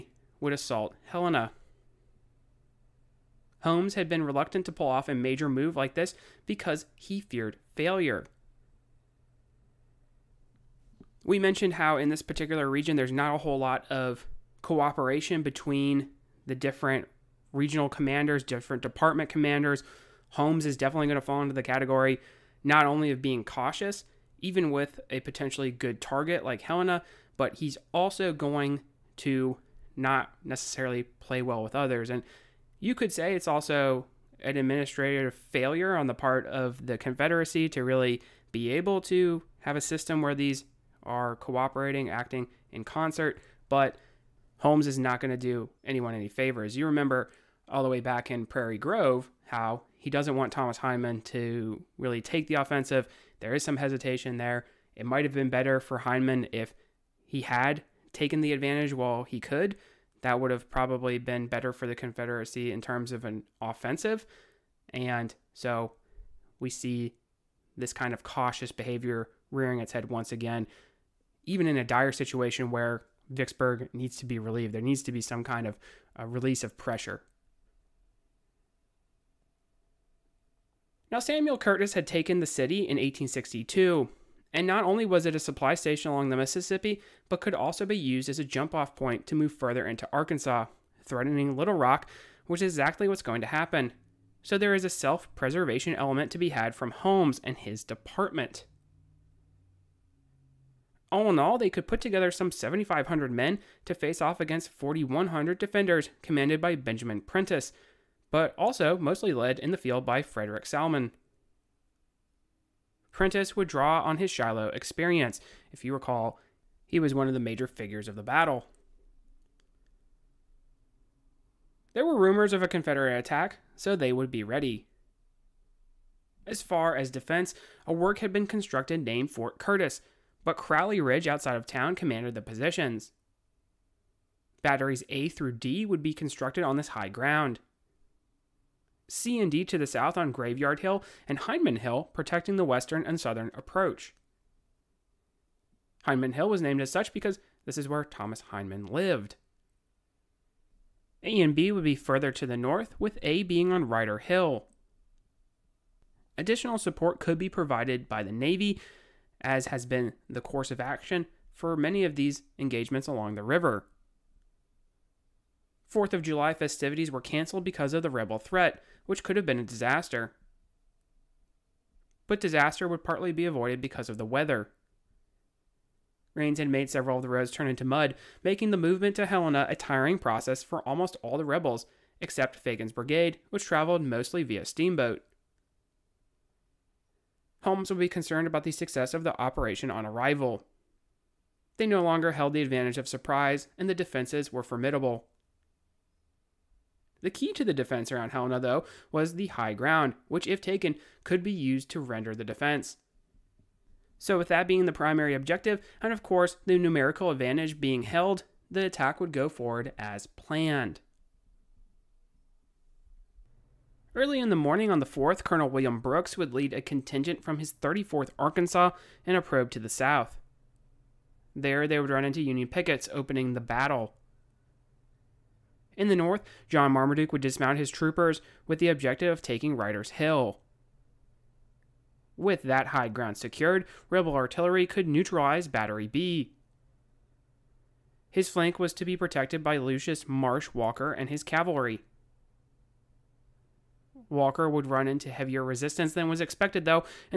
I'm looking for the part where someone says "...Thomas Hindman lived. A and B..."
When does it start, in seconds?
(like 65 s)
148 s.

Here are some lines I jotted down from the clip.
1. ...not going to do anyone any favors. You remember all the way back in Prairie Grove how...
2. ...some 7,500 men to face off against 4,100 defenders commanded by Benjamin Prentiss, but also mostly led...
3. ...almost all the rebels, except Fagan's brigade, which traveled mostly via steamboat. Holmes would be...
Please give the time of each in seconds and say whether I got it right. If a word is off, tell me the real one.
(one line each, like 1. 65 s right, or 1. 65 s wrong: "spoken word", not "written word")
1. 44 s right
2. 102 s right
3. 180 s right.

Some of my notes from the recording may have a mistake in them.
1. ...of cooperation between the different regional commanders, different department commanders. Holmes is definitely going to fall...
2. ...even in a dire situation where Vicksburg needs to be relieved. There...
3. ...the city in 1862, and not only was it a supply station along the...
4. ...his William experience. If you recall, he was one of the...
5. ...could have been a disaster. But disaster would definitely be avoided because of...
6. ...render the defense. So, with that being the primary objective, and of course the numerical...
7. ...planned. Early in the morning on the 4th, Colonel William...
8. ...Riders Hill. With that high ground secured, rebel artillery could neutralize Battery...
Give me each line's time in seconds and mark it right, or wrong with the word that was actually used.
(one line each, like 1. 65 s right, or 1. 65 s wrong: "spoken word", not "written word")
1. 13 s right
2. 71 s right
3. 82 s right
4. 114 s wrong: "Shiloh", not "William"
5. 169 s wrong: "partly", not "definitely"
6. 201 s right
7. 210 s right
8. 229 s right.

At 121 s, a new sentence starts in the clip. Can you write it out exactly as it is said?
There were rumors of a Confederate attack, so they would be ready.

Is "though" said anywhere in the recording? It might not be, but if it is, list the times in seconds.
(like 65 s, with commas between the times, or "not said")
198 s, 246 s.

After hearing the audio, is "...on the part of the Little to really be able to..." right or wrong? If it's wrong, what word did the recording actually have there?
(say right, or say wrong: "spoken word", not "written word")
wrong: "Confederacy", not "Little".